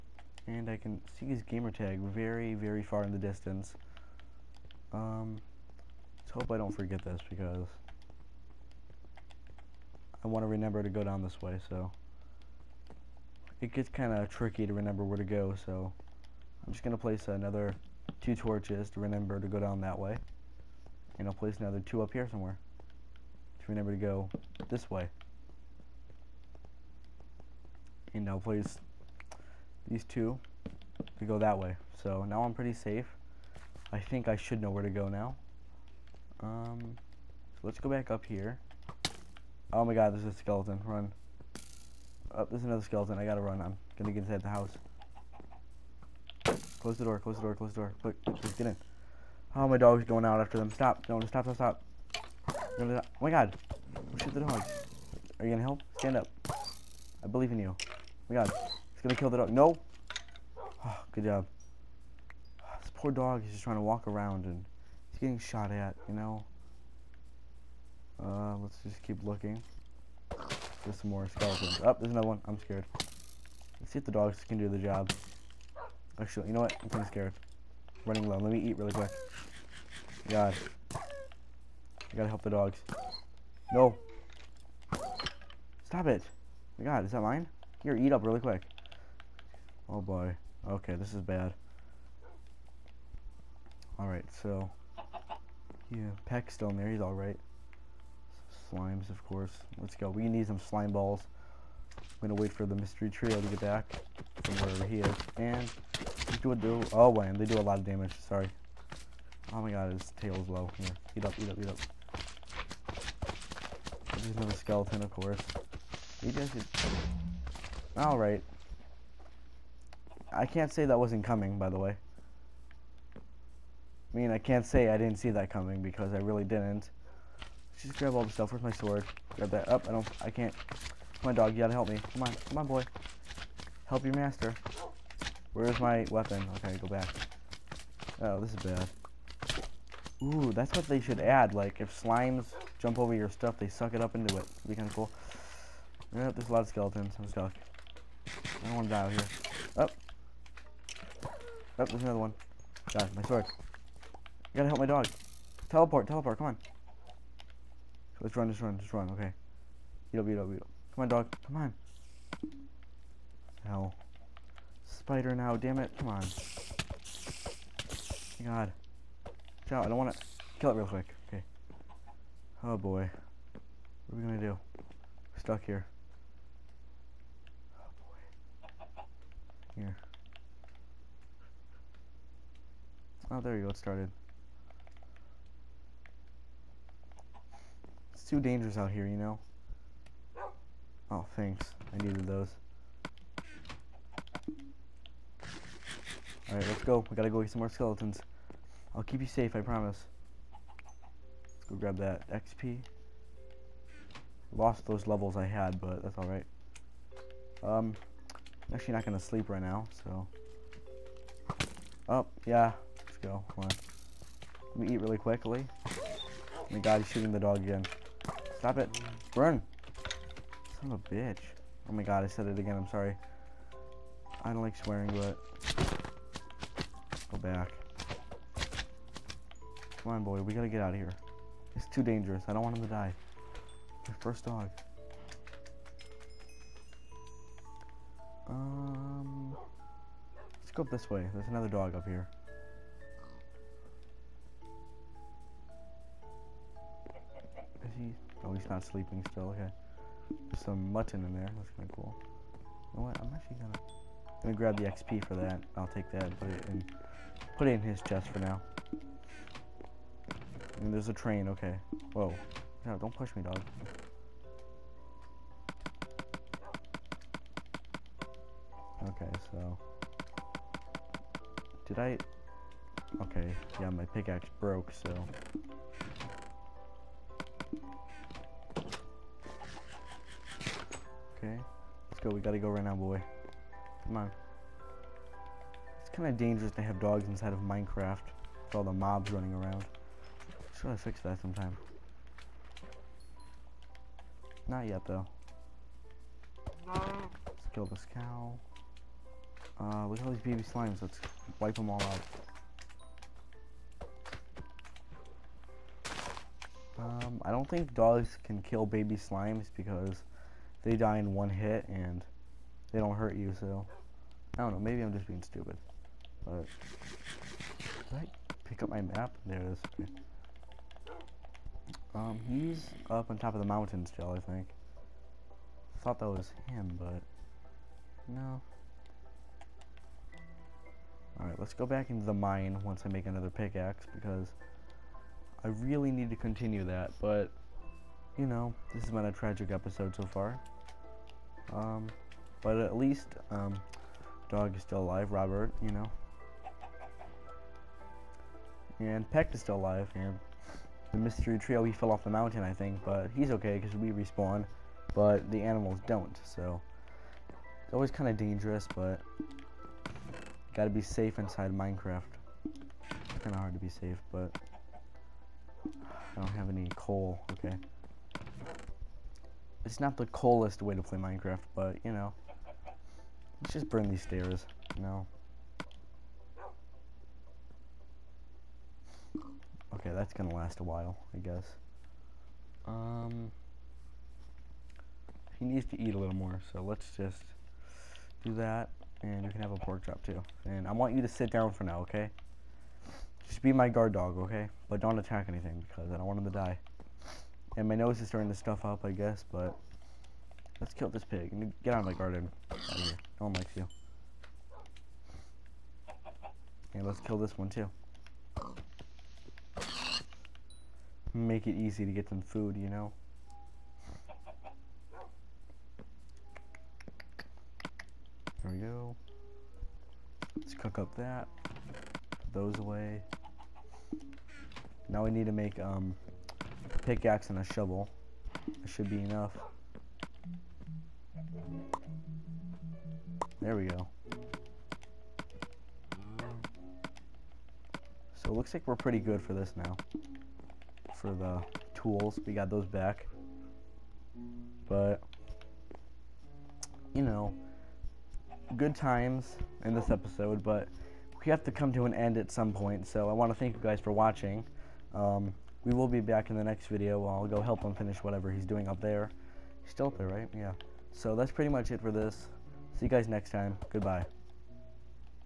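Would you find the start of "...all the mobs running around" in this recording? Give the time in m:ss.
4:48.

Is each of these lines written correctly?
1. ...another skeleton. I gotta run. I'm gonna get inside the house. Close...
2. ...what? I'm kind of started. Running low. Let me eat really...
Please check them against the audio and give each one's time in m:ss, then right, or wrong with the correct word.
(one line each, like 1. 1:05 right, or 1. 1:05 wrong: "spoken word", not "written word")
1. 0:42 right
2. 1:16 wrong: "scared", not "started".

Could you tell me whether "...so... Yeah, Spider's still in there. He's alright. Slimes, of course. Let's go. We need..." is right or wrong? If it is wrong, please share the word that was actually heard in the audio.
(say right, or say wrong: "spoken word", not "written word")
wrong: "Peck", not "Spider".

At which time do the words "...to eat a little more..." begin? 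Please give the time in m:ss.
6:25.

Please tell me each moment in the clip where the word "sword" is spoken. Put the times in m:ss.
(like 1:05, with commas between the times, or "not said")
2:08, 2:33.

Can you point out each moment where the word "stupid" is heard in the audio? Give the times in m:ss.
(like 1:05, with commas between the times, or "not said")
5:15.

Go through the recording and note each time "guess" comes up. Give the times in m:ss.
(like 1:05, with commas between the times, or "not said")
6:21, 6:39.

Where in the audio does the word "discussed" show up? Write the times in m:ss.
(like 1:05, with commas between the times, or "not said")
not said.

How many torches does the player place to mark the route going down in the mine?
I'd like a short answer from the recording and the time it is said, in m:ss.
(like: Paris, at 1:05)
2, at 0:18.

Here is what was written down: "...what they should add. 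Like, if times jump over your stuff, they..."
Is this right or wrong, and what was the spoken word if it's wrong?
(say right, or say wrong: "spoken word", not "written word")
wrong: "slimes", not "times".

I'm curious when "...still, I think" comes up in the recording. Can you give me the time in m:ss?
5:24.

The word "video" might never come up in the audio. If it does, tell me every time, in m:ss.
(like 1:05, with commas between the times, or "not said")
7:36.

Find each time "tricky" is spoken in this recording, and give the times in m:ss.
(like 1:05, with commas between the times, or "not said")
0:14.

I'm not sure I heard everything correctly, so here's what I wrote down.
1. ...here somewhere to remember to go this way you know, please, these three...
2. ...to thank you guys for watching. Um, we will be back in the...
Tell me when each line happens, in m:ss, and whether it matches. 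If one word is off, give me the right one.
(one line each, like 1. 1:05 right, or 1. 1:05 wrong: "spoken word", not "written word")
1. 0:22 wrong: "two", not "three"
2. 7:33 right.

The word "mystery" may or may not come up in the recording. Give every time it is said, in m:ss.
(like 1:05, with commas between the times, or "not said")
1:42, 5:51.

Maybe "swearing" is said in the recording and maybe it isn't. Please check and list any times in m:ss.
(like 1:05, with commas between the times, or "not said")
3:44.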